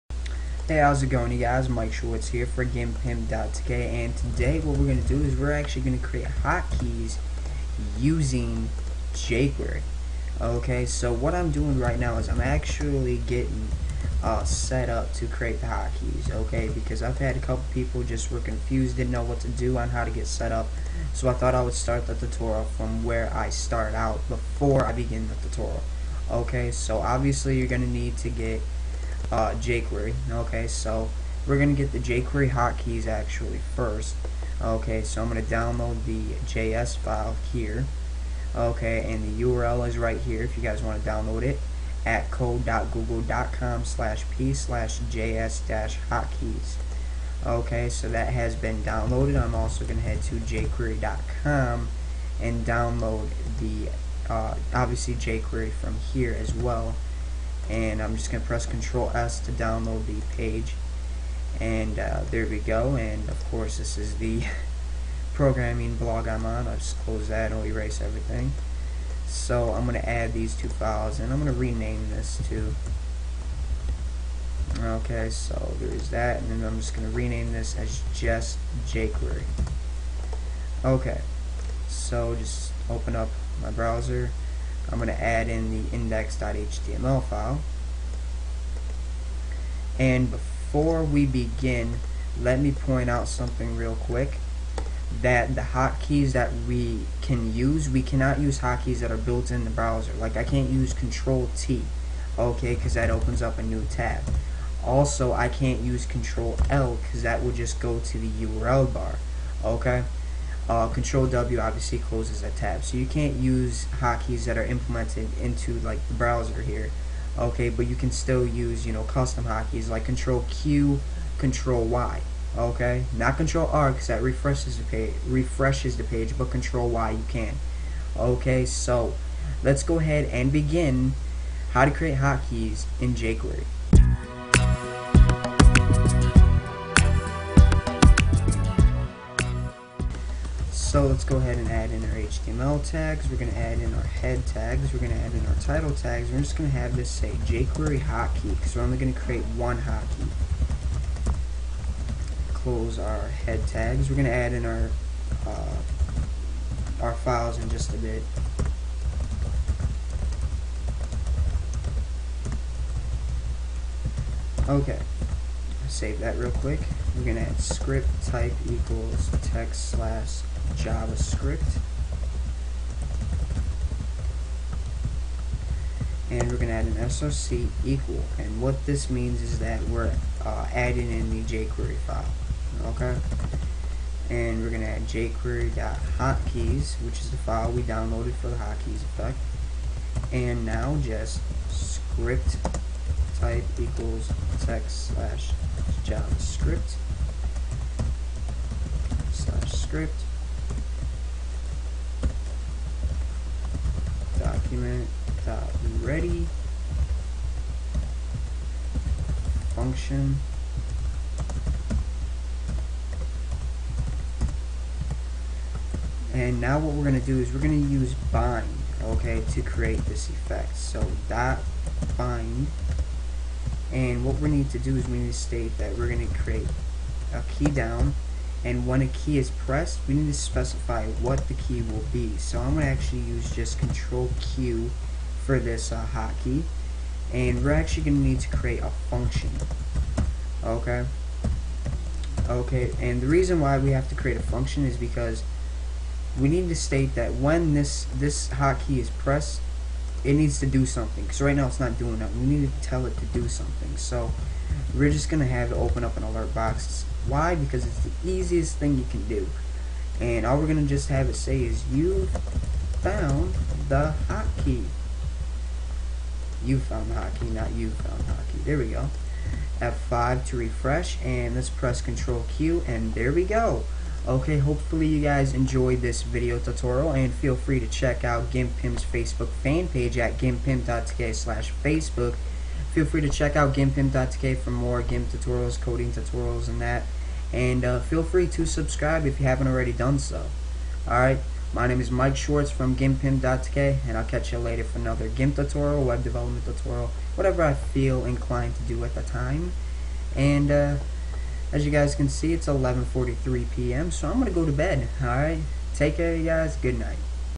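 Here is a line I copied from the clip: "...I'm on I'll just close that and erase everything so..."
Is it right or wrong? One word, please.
right.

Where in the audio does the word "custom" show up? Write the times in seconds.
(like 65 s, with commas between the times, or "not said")
119 s.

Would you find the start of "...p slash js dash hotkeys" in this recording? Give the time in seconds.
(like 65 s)
44 s.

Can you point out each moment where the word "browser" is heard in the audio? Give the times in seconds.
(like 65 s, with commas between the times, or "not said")
83 s, 99 s, 116 s.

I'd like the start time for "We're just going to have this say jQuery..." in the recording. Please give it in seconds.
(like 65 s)
146 s.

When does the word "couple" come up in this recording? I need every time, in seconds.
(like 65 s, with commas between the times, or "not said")
17 s.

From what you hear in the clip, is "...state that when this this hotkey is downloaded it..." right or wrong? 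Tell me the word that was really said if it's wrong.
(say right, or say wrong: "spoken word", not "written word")
wrong: "pressed", not "downloaded".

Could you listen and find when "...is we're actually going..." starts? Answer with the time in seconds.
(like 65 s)
5 s.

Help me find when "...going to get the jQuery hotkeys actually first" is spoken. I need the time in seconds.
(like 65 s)
31 s.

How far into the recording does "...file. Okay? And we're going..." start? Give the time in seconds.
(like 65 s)
182 s.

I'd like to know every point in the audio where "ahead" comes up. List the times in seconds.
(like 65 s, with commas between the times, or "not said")
129 s, 141 s.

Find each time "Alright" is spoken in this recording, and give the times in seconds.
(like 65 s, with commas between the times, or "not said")
291 s, 305 s.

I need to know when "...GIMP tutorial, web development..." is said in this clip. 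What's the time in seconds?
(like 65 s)
295 s.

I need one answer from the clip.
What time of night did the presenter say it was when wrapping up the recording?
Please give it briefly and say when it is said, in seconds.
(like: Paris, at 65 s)
11:43 p.m., at 302 s.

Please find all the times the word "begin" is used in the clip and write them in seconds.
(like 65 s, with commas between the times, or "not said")
24 s, 91 s, 130 s.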